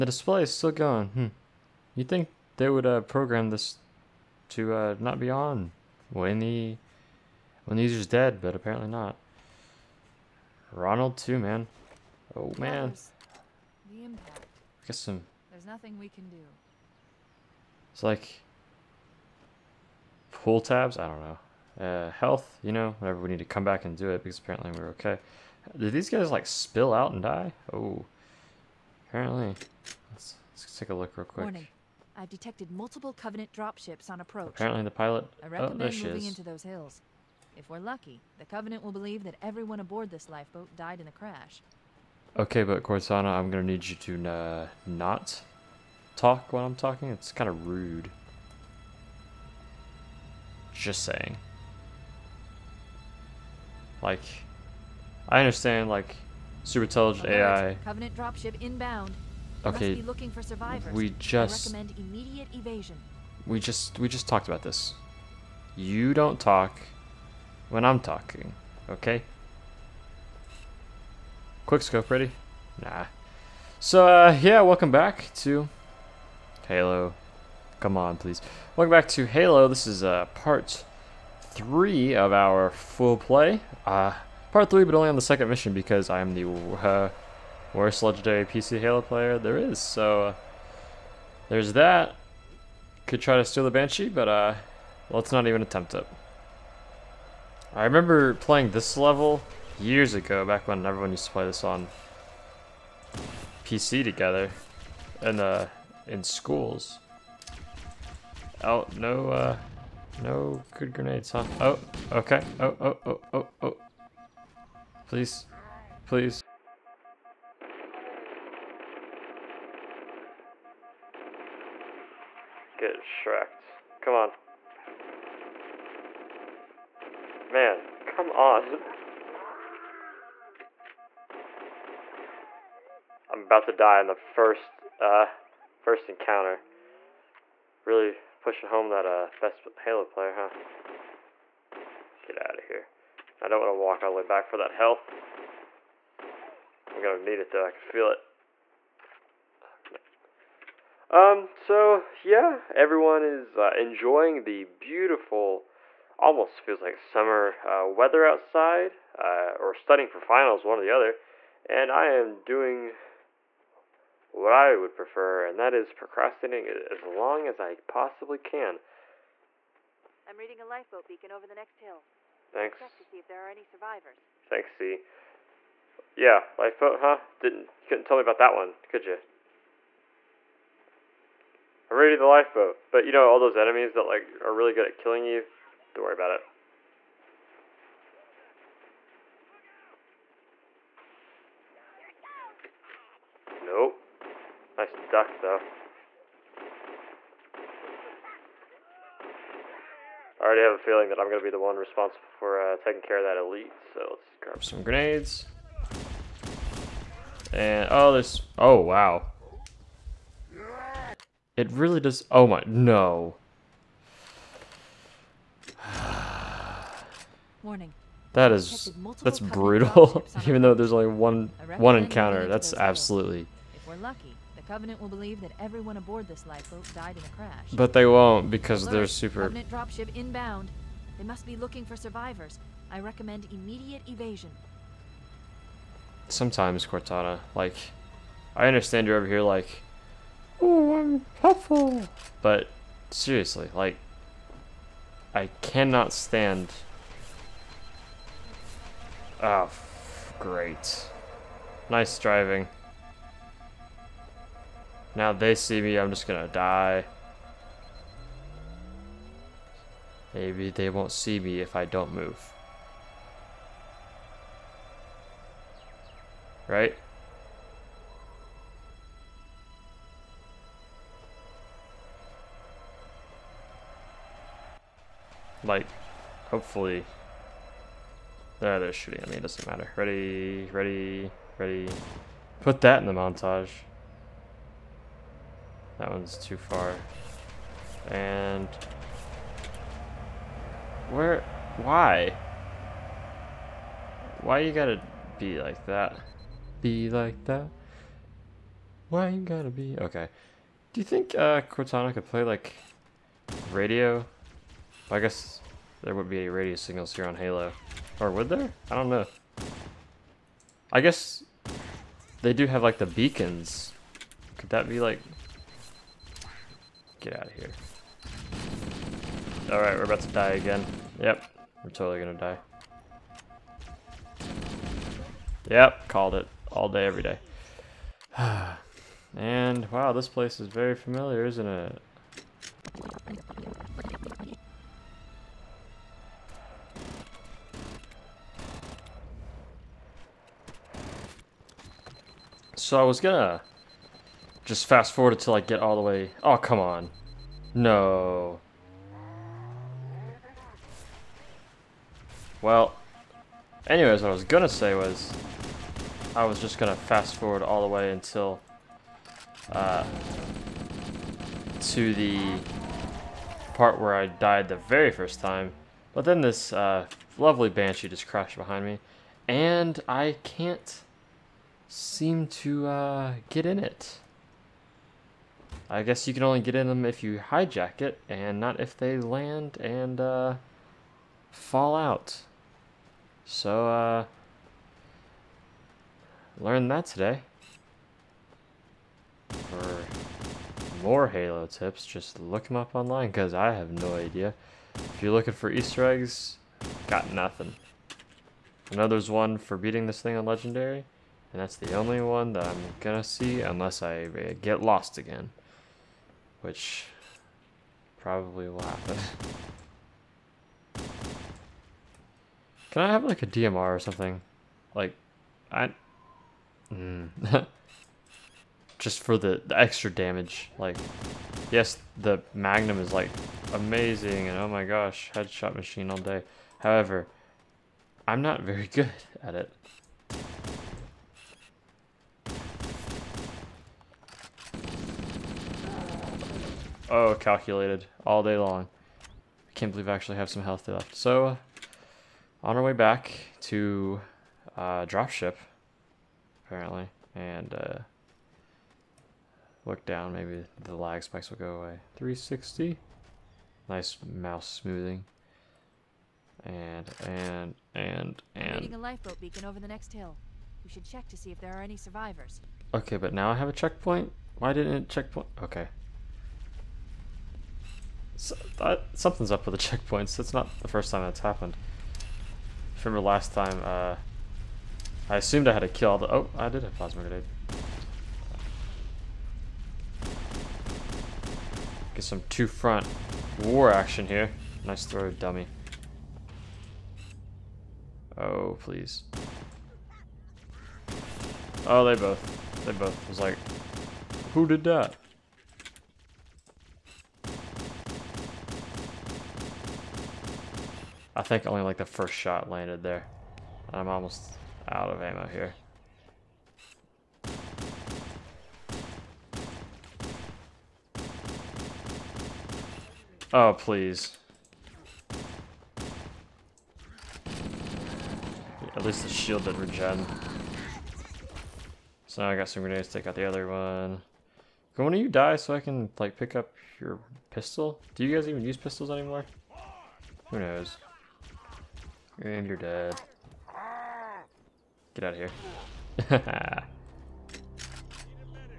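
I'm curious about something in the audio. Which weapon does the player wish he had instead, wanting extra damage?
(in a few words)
DMR.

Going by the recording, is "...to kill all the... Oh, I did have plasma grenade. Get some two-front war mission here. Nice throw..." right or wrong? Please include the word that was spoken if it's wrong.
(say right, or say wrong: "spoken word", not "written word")
wrong: "action", not "mission".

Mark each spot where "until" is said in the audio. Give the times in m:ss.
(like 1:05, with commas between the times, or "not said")
5:45, 5:58.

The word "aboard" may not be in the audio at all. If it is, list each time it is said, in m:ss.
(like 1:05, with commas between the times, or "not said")
0:39, 3:45.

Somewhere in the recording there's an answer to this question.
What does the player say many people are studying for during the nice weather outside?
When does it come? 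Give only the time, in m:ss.
2:40.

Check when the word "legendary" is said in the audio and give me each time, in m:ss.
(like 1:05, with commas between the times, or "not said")
1:28, 6:40.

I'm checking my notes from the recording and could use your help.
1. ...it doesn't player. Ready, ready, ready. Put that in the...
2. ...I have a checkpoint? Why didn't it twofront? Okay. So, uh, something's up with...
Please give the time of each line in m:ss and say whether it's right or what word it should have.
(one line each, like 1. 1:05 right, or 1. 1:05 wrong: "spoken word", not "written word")
1. 4:39 wrong: "matter", not "player"
2. 7:43 wrong: "checkpoint", not "twofront".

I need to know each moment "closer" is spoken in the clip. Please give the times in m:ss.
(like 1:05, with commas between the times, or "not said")
not said.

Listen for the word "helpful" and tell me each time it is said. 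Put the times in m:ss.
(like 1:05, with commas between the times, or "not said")
4:01.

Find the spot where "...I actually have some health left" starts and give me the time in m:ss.
7:20.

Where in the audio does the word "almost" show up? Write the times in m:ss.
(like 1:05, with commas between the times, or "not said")
2:36, 8:24.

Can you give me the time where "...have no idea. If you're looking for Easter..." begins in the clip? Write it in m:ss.
6:33.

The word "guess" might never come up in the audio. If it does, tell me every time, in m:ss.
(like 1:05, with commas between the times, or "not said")
5:05, 5:10, 6:16.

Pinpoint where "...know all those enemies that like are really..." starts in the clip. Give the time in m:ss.
3:03.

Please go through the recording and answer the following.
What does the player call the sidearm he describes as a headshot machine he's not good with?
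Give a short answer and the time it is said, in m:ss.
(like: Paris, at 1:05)
Magnum, at 7:02.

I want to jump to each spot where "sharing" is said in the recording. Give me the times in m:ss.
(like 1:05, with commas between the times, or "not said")
not said.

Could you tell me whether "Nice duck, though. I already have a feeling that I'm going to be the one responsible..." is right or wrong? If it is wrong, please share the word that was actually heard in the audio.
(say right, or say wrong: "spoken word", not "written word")
right.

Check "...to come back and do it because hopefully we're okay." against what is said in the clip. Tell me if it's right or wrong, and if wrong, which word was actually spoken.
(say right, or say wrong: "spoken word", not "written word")
wrong: "apparently", not "hopefully".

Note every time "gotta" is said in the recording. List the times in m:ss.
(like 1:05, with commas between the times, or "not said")
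4:54, 4:59.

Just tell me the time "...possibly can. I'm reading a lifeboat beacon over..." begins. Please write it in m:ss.
2:47.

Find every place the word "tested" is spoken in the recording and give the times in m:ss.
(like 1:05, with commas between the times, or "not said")
not said.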